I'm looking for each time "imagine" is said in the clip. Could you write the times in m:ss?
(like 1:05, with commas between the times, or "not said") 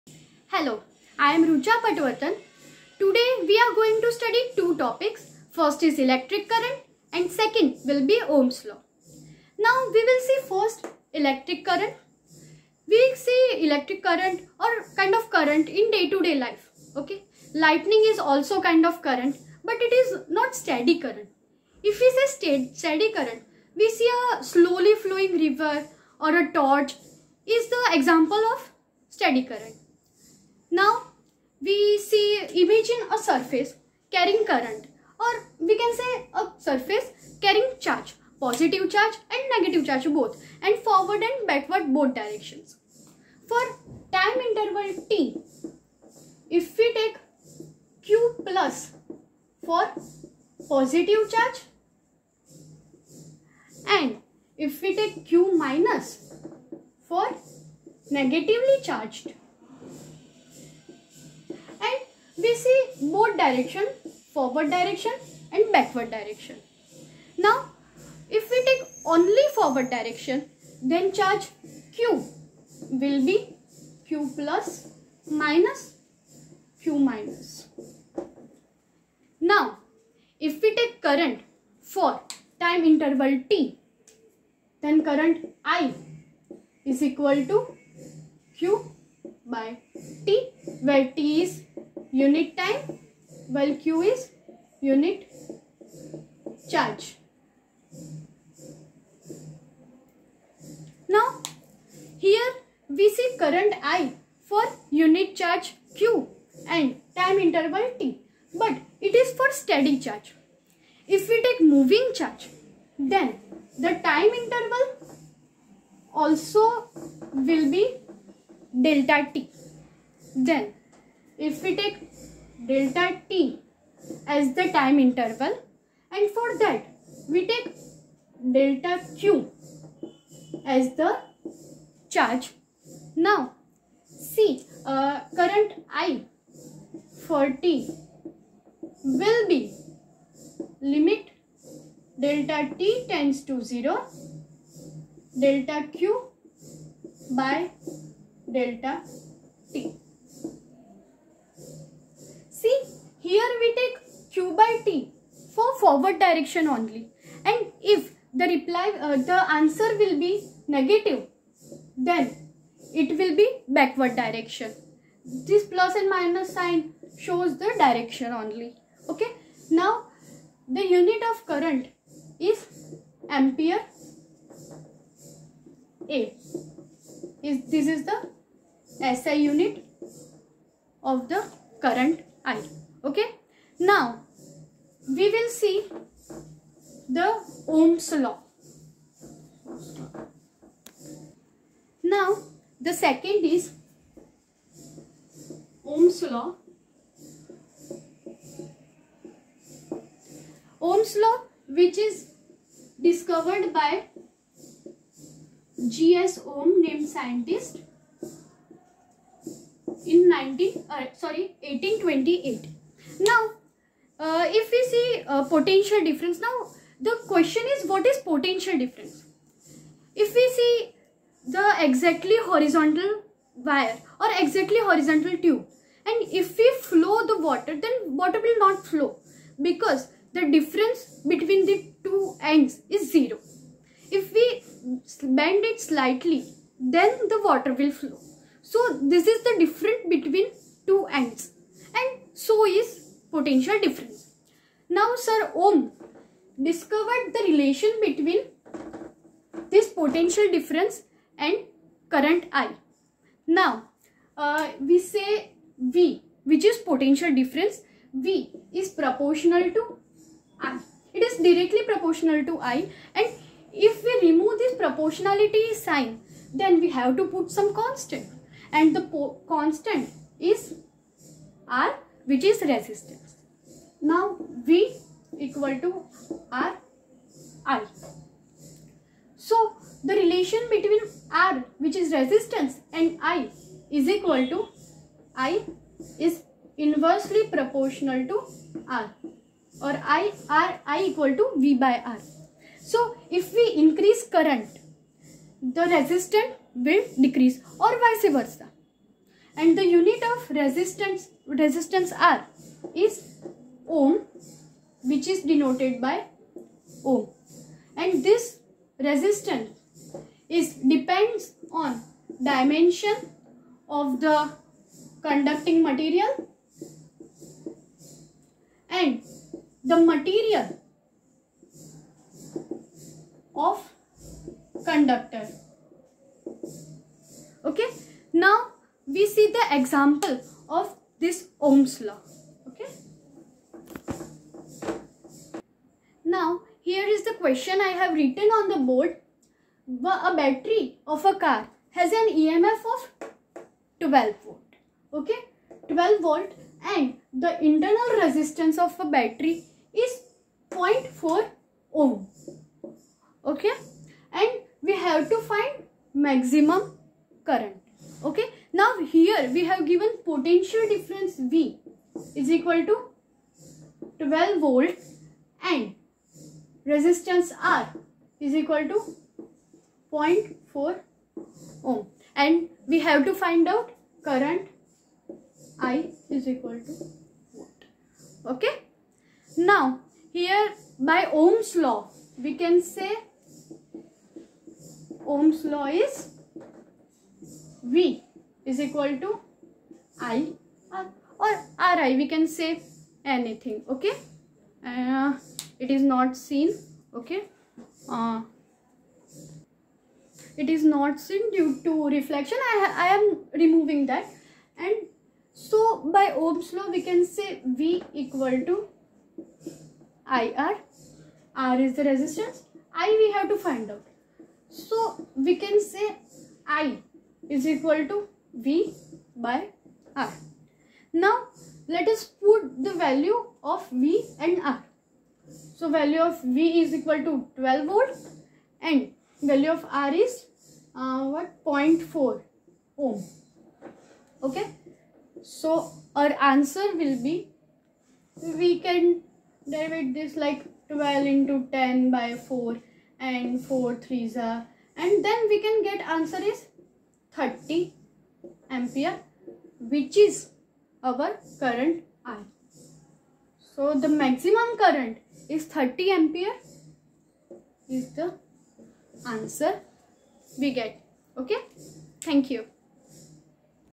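0:32.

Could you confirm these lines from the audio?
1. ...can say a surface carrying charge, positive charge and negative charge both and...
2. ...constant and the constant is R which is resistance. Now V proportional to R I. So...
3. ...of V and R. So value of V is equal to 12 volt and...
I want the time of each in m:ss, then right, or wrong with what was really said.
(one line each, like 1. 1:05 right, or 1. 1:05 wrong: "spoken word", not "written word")
1. 0:35 right
2. 4:27 wrong: "equal", not "proportional"
3. 7:03 right.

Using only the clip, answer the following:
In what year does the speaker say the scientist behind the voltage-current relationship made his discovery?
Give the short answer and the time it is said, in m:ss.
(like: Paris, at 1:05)
1828, at 3:31.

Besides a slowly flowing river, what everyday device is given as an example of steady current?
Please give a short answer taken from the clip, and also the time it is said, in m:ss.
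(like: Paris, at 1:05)
A torch, at 0:26.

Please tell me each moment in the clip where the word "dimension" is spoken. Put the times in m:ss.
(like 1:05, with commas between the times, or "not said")
5:12.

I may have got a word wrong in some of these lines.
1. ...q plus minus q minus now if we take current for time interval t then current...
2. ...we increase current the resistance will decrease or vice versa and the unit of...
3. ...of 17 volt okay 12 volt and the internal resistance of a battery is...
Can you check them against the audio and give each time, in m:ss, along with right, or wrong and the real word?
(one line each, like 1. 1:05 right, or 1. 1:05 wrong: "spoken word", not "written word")
1. 1:14 right
2. 4:53 right
3. 5:42 wrong: "12", not "17".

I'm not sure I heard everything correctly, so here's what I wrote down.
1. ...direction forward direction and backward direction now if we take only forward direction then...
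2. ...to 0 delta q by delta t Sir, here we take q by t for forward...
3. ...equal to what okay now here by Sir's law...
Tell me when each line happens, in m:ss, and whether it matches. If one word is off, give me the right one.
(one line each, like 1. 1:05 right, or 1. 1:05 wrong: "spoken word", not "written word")
1. 1:03 right
2. 2:23 wrong: "See", not "Sir"
3. 6:16 wrong: "Ohm", not "Sir".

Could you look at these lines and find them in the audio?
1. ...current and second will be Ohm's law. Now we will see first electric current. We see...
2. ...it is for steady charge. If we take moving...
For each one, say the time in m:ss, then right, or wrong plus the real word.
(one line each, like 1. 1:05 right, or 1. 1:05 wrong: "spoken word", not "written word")
1. 0:06 right
2. 1:48 right.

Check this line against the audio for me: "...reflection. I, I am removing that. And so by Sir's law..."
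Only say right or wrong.
wrong.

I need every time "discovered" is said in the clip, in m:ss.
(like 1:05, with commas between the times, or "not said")
3:22, 4:06.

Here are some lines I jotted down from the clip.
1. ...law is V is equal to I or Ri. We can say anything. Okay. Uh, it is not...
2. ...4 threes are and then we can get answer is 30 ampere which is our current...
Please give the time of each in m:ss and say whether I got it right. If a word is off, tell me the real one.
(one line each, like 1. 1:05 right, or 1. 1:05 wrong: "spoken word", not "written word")
1. 6:25 right
2. 7:23 right.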